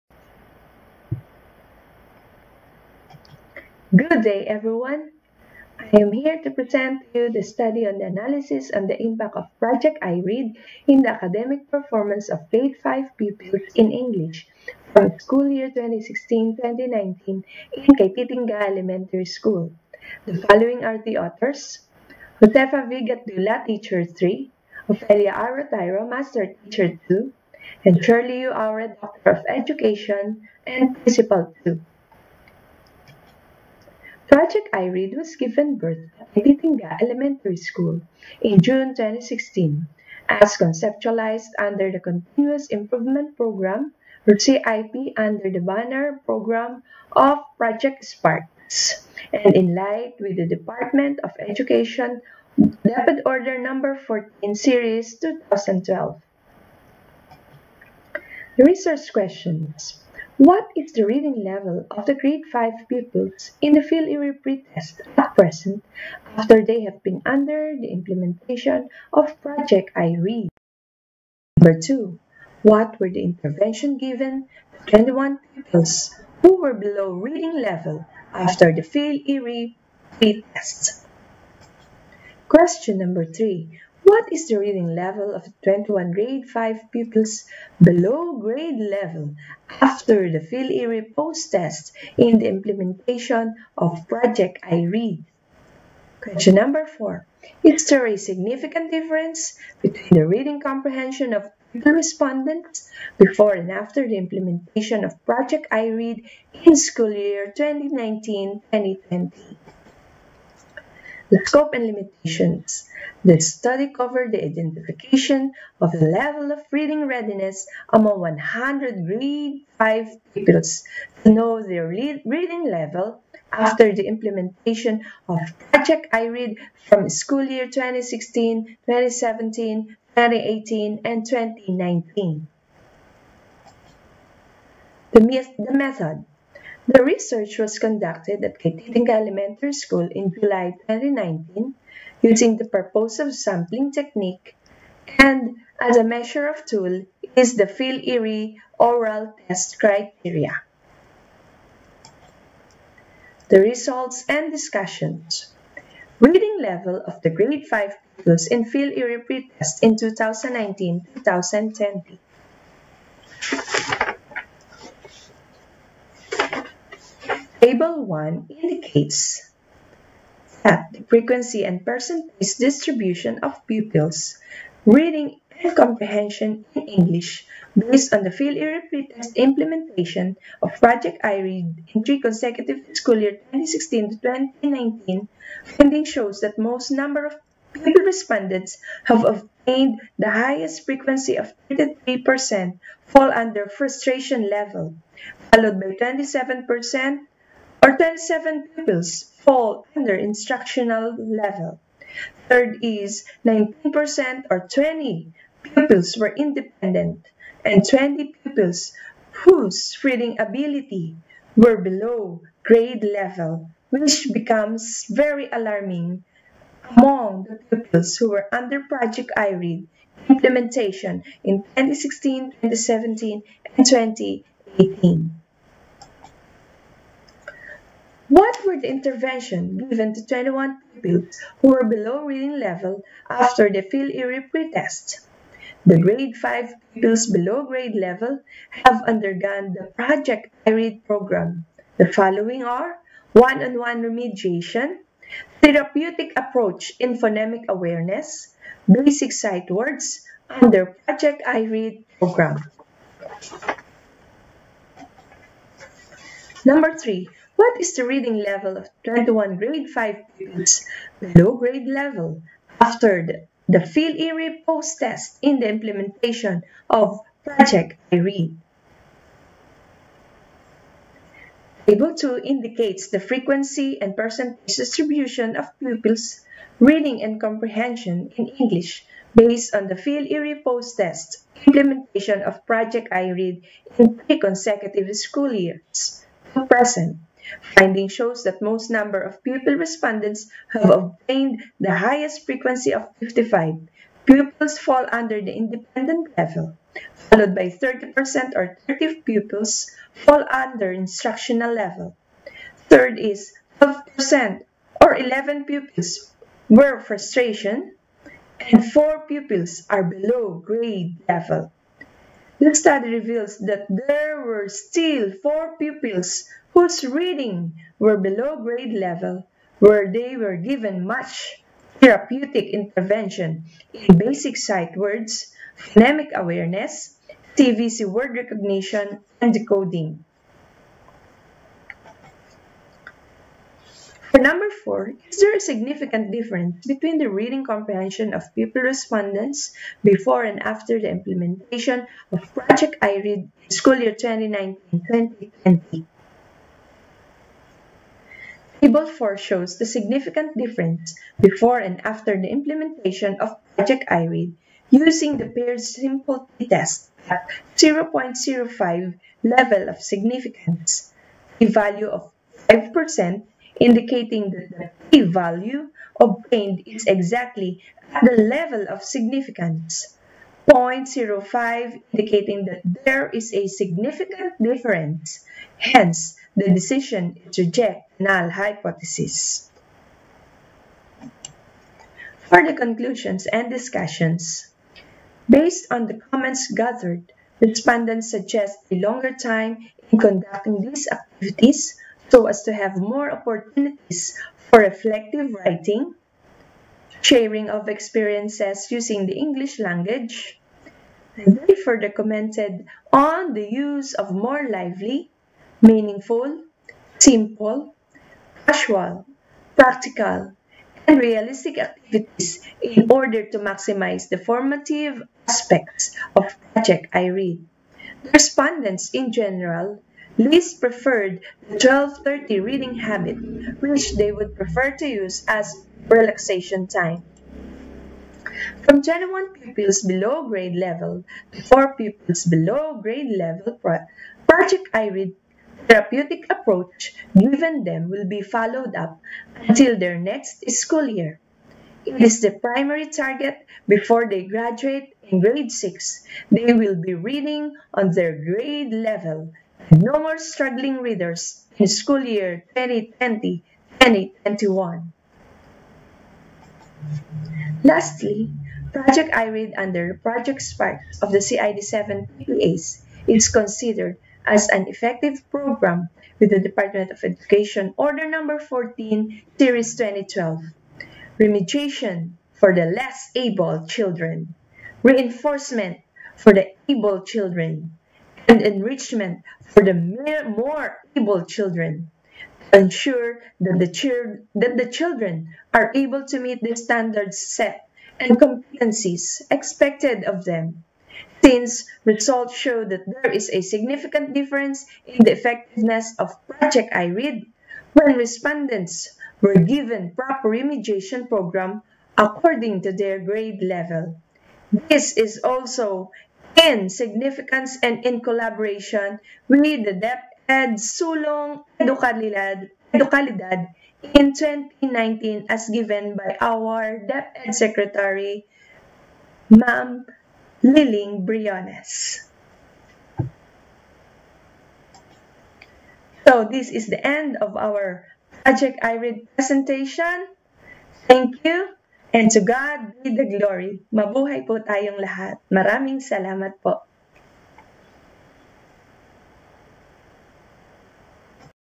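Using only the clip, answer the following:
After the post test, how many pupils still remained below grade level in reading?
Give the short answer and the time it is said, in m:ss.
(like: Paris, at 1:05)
4, at 5:08.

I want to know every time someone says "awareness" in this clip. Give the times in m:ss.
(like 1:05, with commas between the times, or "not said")
4:07, 5:26.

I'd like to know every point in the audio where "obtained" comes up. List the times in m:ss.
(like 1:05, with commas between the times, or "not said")
3:09, 4:50, 6:06.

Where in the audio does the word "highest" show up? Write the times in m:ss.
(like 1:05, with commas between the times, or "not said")
3:10, 4:51.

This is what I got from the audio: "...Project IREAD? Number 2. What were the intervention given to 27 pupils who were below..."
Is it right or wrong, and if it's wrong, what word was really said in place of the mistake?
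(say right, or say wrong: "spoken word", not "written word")
wrong: "21", not "27".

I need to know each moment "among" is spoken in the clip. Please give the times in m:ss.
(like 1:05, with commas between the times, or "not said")
1:57, 3:36.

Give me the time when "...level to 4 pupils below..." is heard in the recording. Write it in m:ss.
7:10.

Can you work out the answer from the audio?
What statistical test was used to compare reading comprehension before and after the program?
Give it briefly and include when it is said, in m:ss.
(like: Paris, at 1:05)
Paired sample test, at 5:55.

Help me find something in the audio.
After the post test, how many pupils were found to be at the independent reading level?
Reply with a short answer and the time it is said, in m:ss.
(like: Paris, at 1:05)
55, at 4:53.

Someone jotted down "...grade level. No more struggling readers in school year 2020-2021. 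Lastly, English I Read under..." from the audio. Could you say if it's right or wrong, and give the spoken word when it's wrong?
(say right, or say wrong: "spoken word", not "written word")
wrong: "Project", not "English".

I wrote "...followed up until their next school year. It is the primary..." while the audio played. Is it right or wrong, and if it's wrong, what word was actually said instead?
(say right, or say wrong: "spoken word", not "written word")
right.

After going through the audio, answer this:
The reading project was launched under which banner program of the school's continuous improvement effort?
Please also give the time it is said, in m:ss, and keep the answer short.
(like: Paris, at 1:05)
Project Sparks, at 0:47.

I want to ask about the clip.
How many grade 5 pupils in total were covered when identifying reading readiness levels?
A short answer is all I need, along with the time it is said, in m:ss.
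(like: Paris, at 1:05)
100, at 1:58.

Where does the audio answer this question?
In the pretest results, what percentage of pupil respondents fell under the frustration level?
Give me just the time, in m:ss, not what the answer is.
3:11.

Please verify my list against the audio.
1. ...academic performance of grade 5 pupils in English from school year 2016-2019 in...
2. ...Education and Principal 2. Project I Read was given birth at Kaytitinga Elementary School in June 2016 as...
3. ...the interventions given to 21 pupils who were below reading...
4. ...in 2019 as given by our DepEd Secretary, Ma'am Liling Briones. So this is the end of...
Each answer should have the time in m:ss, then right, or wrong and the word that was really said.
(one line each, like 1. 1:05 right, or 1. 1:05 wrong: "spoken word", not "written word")
1. 0:11 right
2. 0:29 right
3. 3:48 right
4. 8:34 right.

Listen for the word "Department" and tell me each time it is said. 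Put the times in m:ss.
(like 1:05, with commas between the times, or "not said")
0:50, 7:46.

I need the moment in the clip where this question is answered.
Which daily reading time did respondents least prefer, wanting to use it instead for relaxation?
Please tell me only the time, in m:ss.
7:01.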